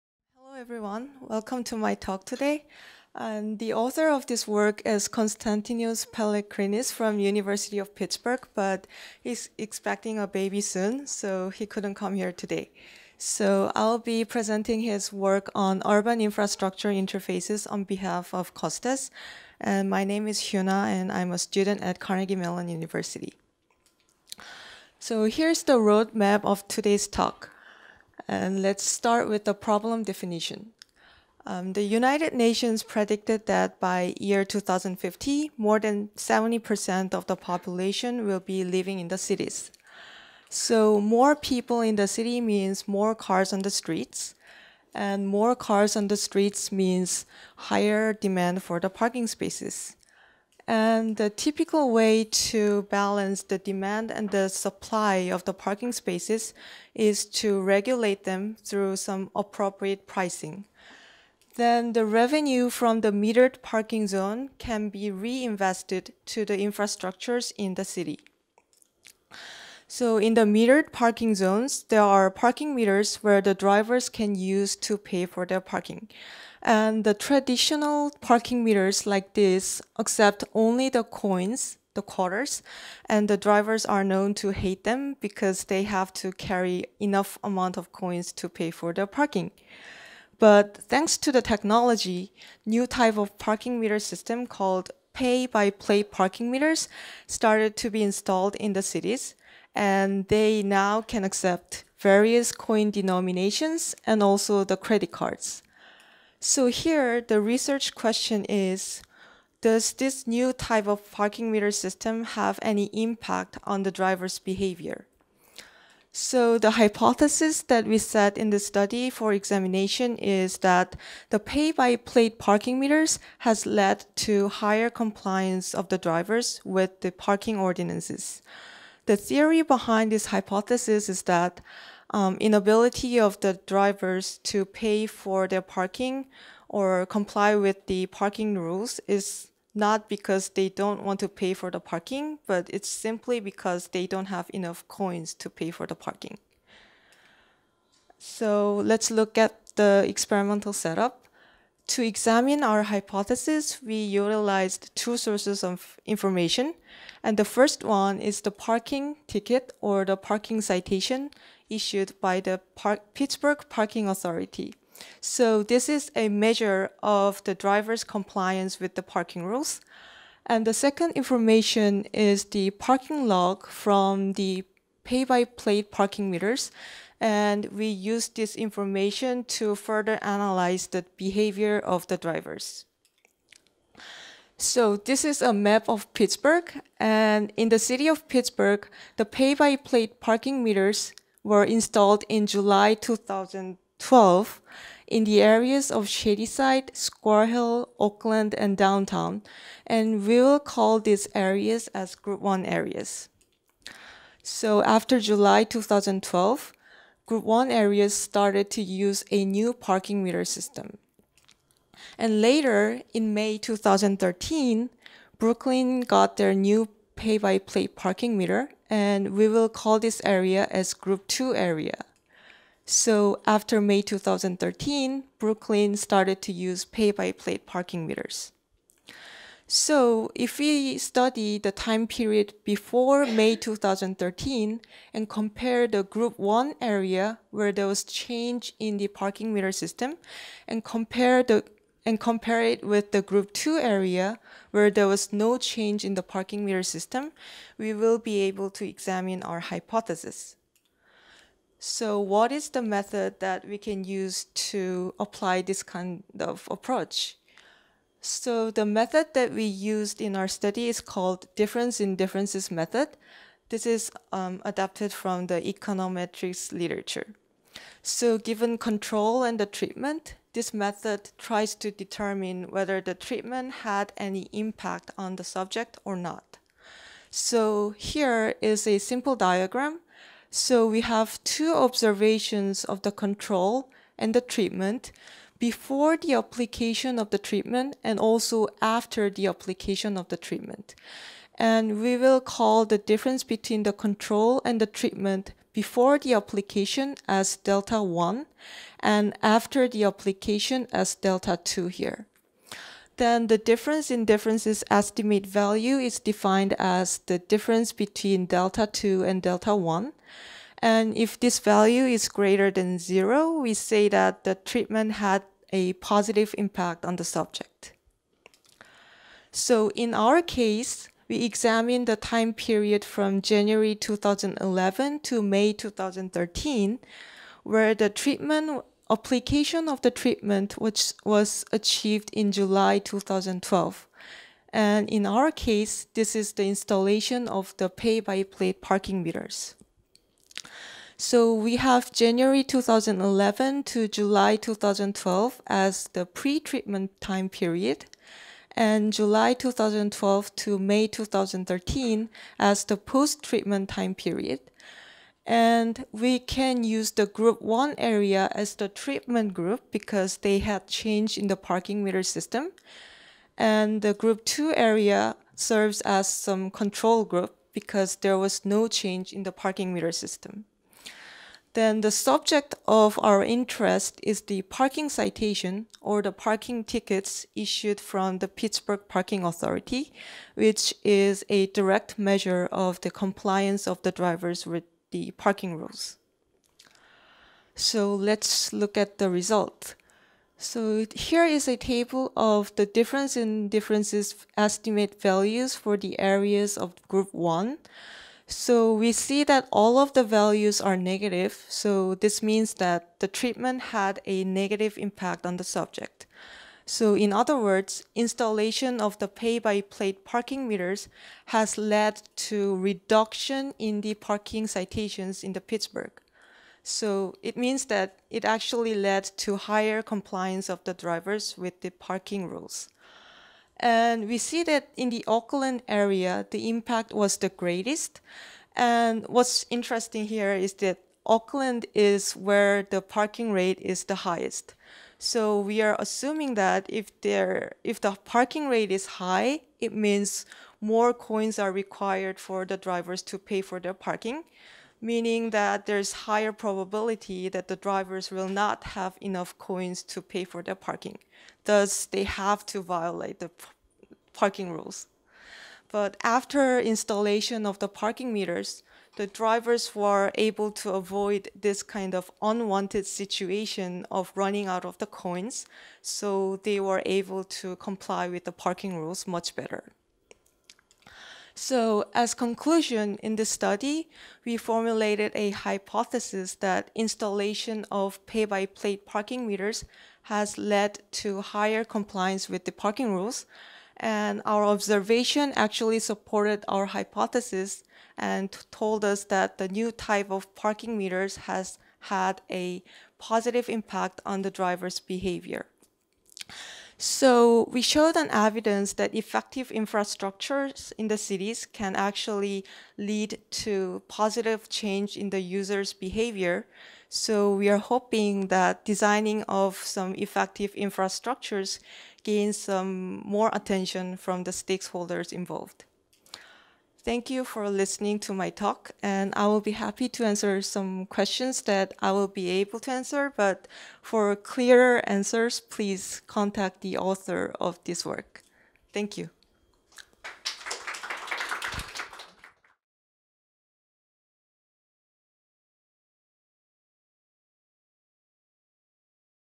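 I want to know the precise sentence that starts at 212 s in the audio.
And later, in May 2013, Brookline got their new pay-by-plate parking meter and we will call this area as Group 2 area.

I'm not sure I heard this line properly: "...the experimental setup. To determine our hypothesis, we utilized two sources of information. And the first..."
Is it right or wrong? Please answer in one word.
wrong.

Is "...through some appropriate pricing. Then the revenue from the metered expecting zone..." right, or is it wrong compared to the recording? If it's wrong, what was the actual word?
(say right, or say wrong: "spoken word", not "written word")
wrong: "parking", not "expecting".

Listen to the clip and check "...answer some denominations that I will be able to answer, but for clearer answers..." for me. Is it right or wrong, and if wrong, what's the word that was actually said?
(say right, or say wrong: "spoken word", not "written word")
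wrong: "questions", not "denominations".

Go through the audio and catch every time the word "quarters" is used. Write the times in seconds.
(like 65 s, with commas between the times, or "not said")
82 s.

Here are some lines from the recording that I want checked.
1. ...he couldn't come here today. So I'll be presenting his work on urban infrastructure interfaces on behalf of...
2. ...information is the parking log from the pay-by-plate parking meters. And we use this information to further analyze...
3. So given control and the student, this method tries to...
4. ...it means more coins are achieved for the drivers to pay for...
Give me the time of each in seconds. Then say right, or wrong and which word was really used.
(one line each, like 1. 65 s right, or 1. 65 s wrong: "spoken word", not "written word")
1. 11 s right
2. 171 s right
3. 268 s wrong: "treatment", not "student"
4. 439 s wrong: "required", not "achieved".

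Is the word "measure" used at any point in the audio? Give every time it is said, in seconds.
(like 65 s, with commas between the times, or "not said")
166 s, 382 s.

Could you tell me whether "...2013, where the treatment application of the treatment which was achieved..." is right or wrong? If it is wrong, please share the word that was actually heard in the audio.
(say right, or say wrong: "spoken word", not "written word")
right.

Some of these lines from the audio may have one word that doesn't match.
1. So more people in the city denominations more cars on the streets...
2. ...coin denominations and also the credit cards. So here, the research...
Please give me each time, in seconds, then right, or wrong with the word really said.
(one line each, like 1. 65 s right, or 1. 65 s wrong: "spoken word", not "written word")
1. 40 s wrong: "means", not "denominations"
2. 102 s right.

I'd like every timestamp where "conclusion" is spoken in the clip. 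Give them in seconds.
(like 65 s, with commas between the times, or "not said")
472 s.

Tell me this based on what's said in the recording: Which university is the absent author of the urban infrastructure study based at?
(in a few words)
University of Pittsburgh.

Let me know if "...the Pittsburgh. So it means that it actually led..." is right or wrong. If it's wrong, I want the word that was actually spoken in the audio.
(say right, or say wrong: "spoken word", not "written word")
right.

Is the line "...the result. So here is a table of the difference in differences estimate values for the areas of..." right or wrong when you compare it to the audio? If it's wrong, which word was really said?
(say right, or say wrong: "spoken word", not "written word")
right.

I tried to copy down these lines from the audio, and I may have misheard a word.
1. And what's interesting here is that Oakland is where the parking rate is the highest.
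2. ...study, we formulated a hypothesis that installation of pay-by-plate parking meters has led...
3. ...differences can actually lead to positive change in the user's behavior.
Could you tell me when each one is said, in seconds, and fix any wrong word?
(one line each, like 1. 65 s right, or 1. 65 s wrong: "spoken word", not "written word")
1. 428 s right
2. 473 s right
3. 501 s wrong: "cities", not "differences".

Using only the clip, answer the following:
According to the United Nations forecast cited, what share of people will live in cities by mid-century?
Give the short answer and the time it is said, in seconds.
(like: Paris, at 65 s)
More than 70%, at 35 s.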